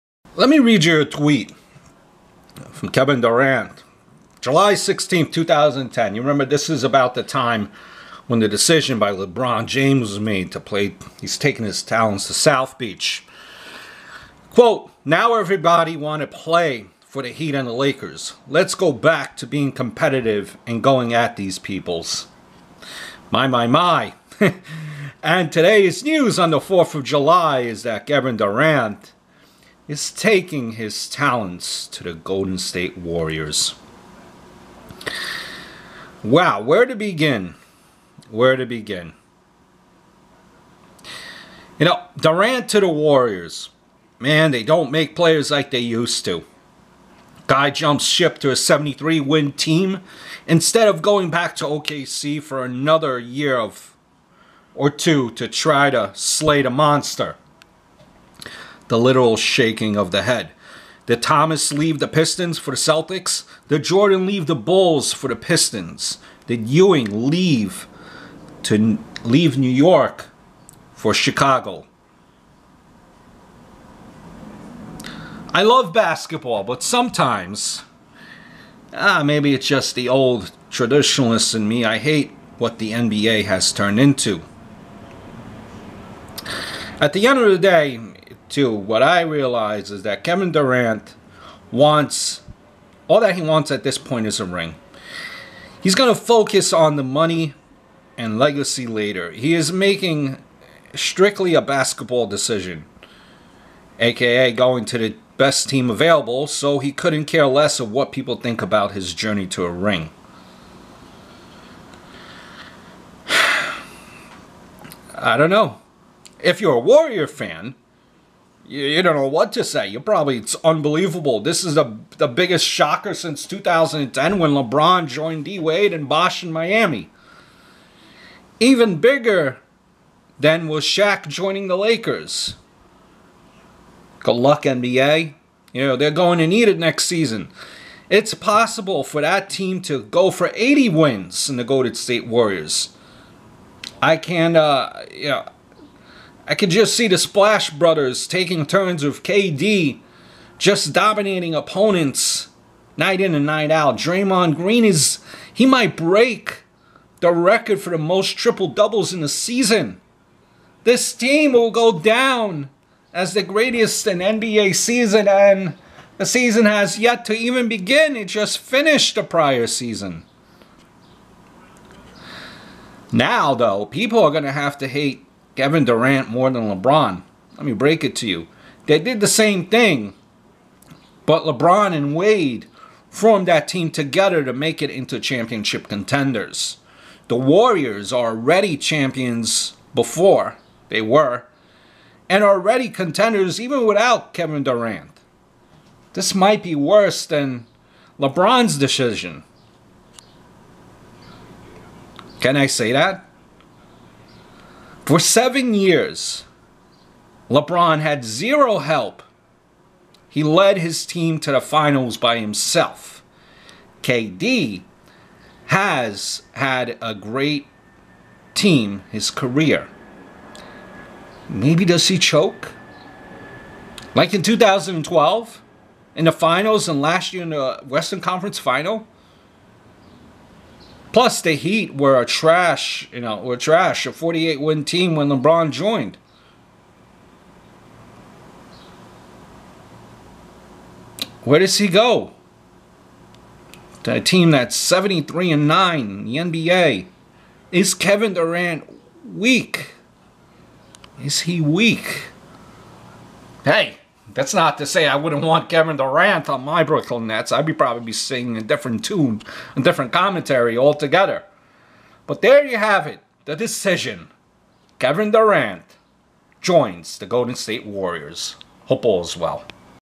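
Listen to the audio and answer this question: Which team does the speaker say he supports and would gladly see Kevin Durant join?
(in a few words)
Brooklyn Nets.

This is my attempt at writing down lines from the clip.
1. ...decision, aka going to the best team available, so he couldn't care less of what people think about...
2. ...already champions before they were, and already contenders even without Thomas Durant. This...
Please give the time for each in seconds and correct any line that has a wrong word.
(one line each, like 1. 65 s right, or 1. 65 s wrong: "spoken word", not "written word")
1. 102 s right
2. 188 s wrong: "Kevin", not "Thomas".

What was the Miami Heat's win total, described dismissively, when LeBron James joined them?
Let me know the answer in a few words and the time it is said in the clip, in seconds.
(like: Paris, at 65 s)
48, at 234 s.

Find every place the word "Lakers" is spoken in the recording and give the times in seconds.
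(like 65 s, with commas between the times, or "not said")
17 s, 131 s.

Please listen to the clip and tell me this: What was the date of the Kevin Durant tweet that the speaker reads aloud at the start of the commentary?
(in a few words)
July 16, 2010.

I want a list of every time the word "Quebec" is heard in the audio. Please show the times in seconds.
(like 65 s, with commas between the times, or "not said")
not said.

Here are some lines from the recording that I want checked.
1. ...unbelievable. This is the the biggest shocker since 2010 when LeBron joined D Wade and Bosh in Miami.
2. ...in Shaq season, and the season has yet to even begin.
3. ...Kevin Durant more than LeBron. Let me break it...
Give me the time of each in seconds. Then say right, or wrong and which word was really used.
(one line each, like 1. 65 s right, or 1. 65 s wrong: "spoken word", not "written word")
1. 120 s right
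2. 164 s wrong: "NBA", not "Shaq"
3. 175 s right.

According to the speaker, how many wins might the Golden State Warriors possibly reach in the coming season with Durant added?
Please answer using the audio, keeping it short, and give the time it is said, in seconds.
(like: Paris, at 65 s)
80, at 140 s.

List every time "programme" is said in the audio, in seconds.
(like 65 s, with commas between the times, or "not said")
not said.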